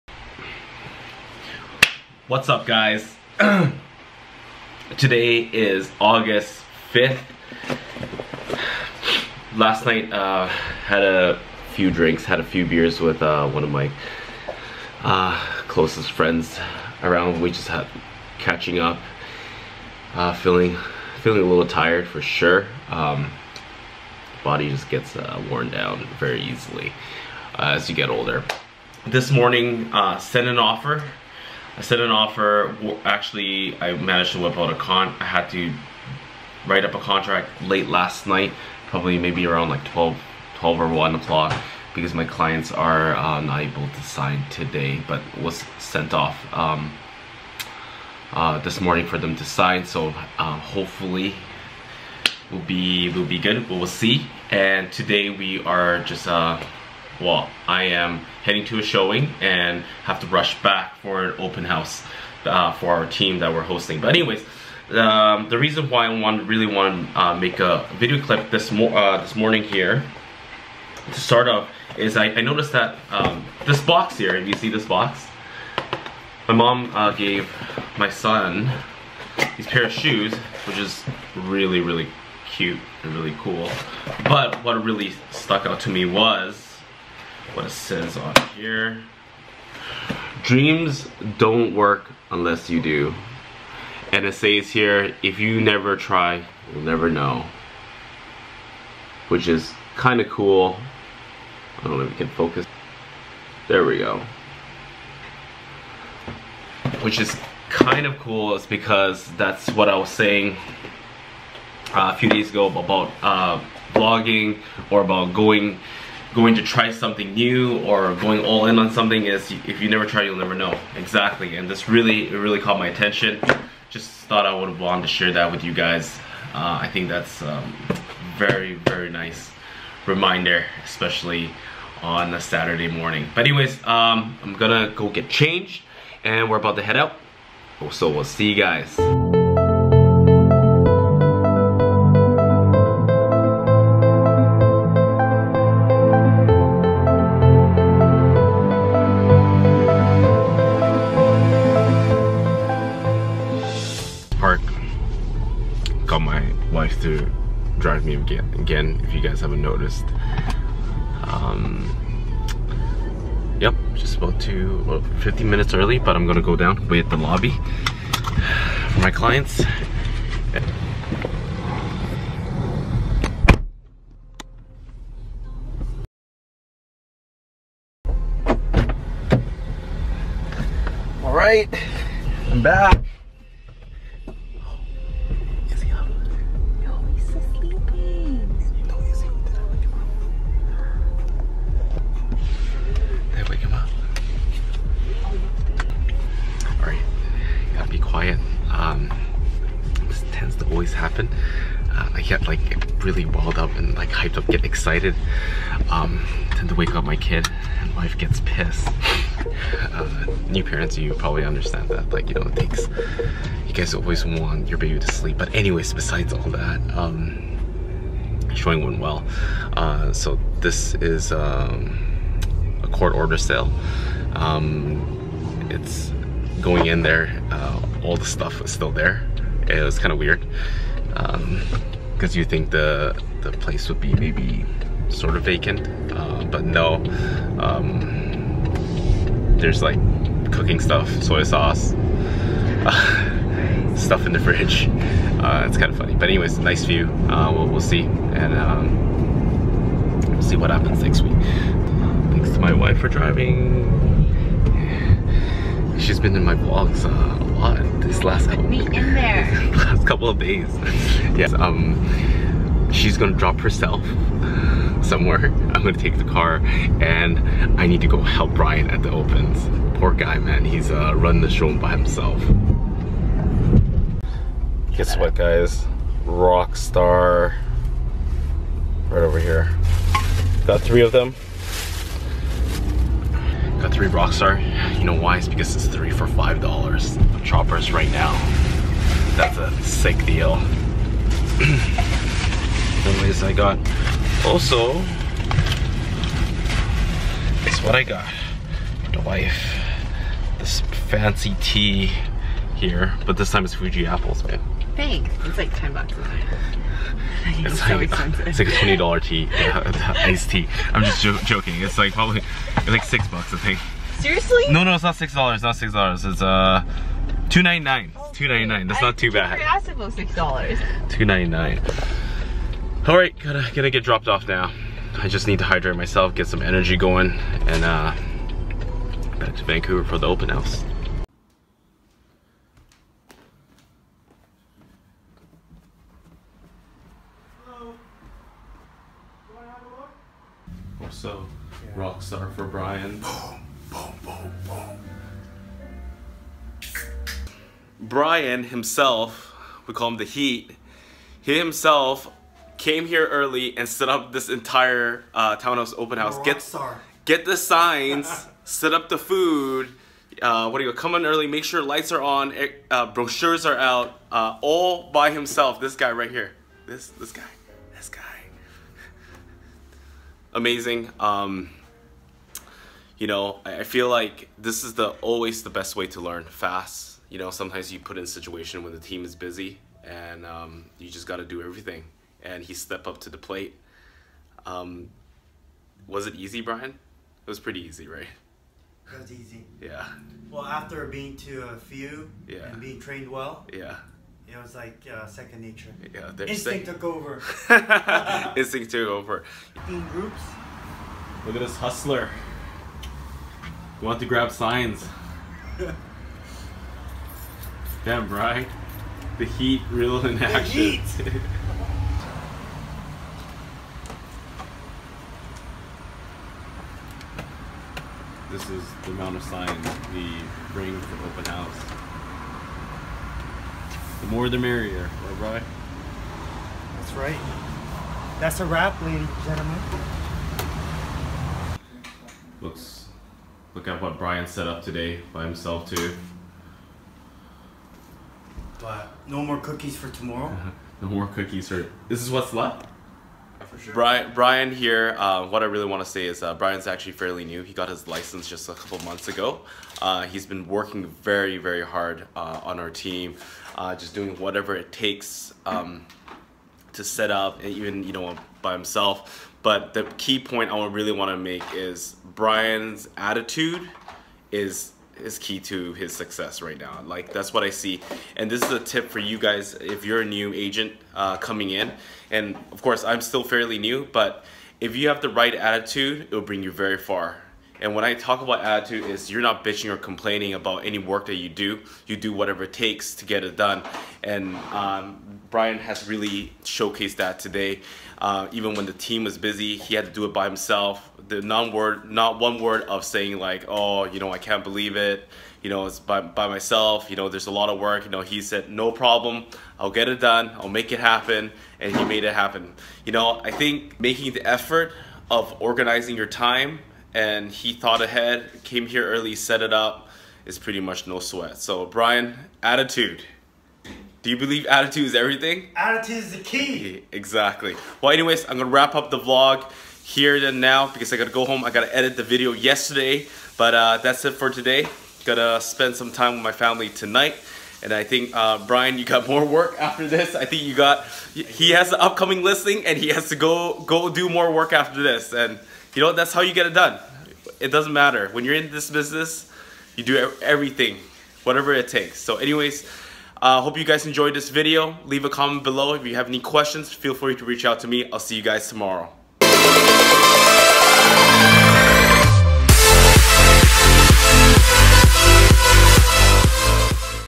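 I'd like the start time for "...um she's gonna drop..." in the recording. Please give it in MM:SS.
04:21.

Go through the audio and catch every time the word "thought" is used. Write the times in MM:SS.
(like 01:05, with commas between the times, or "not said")
02:04, 08:27.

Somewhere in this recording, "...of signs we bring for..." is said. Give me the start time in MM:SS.
06:59.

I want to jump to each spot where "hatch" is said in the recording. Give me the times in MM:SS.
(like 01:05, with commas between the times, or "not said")
not said.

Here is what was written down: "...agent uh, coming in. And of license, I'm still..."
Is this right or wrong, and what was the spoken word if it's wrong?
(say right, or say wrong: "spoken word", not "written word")
wrong: "course", not "license".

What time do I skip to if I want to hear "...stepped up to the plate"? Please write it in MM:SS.
06:22.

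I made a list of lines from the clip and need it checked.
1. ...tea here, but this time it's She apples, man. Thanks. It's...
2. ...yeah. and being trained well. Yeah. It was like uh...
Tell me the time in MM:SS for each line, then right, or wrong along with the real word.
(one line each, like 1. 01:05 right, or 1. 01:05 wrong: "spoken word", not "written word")
1. 05:01 wrong: "Fuji", not "She"
2. 06:32 right.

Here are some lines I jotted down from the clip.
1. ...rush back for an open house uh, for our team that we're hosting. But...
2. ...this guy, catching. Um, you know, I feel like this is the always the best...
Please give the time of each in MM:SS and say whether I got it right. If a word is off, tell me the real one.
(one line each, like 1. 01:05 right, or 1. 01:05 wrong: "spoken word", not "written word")
1. 01:00 right
2. 06:07 wrong: "amazing", not "catching".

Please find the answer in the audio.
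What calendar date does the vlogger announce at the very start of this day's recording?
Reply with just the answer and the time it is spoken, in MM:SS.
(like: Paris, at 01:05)
August 5th, at 00:05.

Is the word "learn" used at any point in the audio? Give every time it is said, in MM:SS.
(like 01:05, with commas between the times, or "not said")
06:16.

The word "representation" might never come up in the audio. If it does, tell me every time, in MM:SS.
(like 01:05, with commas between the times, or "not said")
not said.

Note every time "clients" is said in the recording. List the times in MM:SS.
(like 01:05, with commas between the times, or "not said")
00:42, 02:49.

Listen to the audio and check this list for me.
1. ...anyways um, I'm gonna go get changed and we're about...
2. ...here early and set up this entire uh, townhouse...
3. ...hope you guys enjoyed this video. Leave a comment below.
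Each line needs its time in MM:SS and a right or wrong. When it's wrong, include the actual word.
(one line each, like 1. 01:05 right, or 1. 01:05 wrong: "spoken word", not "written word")
1. 02:13 right
2. 05:53 right
3. 09:03 right.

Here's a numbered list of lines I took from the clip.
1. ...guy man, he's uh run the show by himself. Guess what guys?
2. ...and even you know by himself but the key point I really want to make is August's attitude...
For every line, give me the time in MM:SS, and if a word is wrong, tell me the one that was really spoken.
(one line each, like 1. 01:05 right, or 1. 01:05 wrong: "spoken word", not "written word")
1. 04:30 right
2. 07:37 wrong: "Brian", not "August".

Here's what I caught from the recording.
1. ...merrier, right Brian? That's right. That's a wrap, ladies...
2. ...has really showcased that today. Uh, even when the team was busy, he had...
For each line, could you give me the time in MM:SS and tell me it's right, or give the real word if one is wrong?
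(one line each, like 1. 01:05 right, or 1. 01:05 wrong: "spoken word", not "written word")
1. 07:04 right
2. 08:05 right.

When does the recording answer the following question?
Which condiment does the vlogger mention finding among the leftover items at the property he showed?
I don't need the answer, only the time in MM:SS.
04:01.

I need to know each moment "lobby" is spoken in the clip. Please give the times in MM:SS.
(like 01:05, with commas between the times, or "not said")
02:47.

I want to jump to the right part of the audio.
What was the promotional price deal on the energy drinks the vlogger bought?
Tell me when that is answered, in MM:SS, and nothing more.
04:45.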